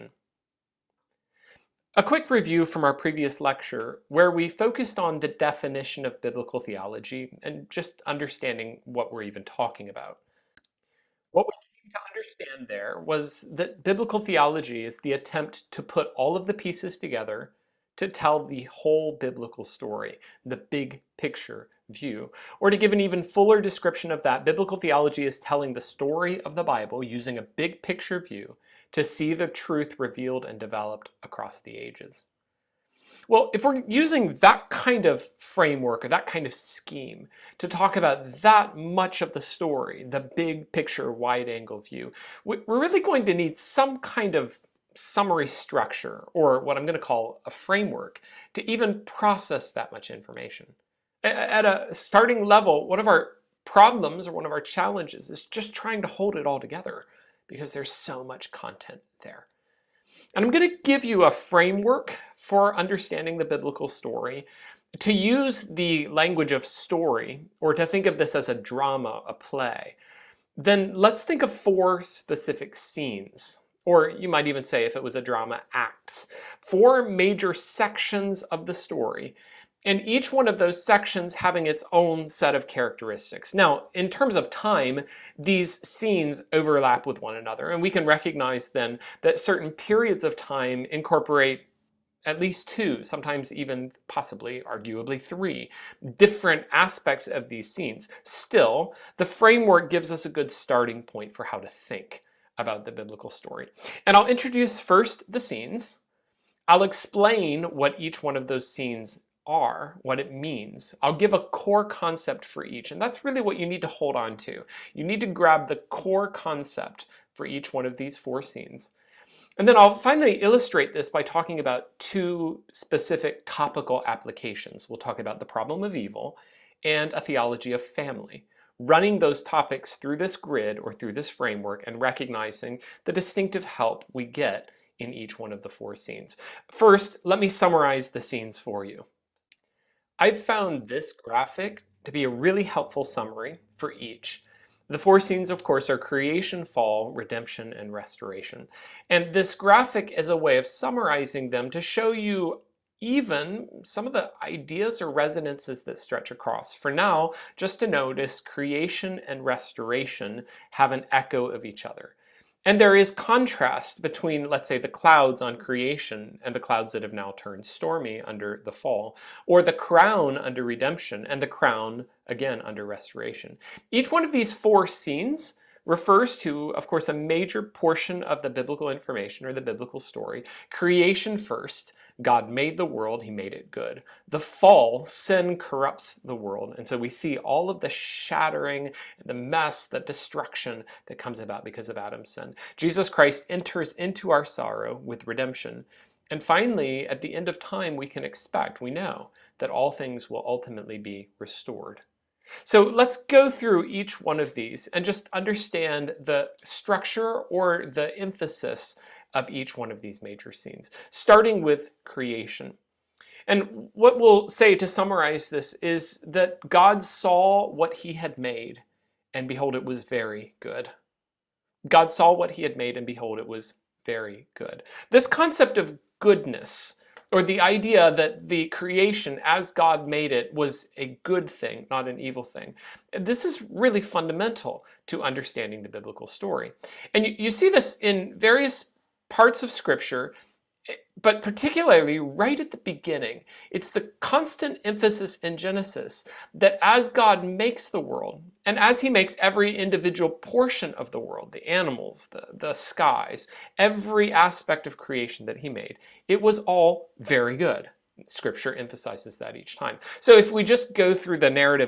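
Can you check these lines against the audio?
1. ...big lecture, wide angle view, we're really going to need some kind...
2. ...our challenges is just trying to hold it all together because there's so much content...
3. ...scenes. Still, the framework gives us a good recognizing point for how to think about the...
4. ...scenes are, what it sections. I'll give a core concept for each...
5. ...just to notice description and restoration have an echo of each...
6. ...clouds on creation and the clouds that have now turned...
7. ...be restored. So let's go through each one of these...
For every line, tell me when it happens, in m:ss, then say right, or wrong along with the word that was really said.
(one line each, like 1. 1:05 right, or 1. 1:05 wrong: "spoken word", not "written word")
1. 0:40 wrong: "picture", not "lecture"
2. 0:54 right
3. 1:37 wrong: "starting", not "recognizing"
4. 1:48 wrong: "means", not "sections"
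5. 2:37 wrong: "creation", not "description"
6. 2:44 right
7. 3:20 right.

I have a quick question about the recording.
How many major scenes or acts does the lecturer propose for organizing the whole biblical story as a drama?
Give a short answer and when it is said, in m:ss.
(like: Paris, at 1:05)
4, at 1:11.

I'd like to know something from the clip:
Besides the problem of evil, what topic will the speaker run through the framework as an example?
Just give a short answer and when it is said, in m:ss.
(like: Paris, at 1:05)
theology of family, at 2:07.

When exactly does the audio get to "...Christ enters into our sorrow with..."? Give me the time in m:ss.
3:13.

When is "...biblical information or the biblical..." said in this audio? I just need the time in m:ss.
2:58.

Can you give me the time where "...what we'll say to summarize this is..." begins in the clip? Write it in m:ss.
3:33.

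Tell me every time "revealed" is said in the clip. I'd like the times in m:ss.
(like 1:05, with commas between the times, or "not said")
0:29.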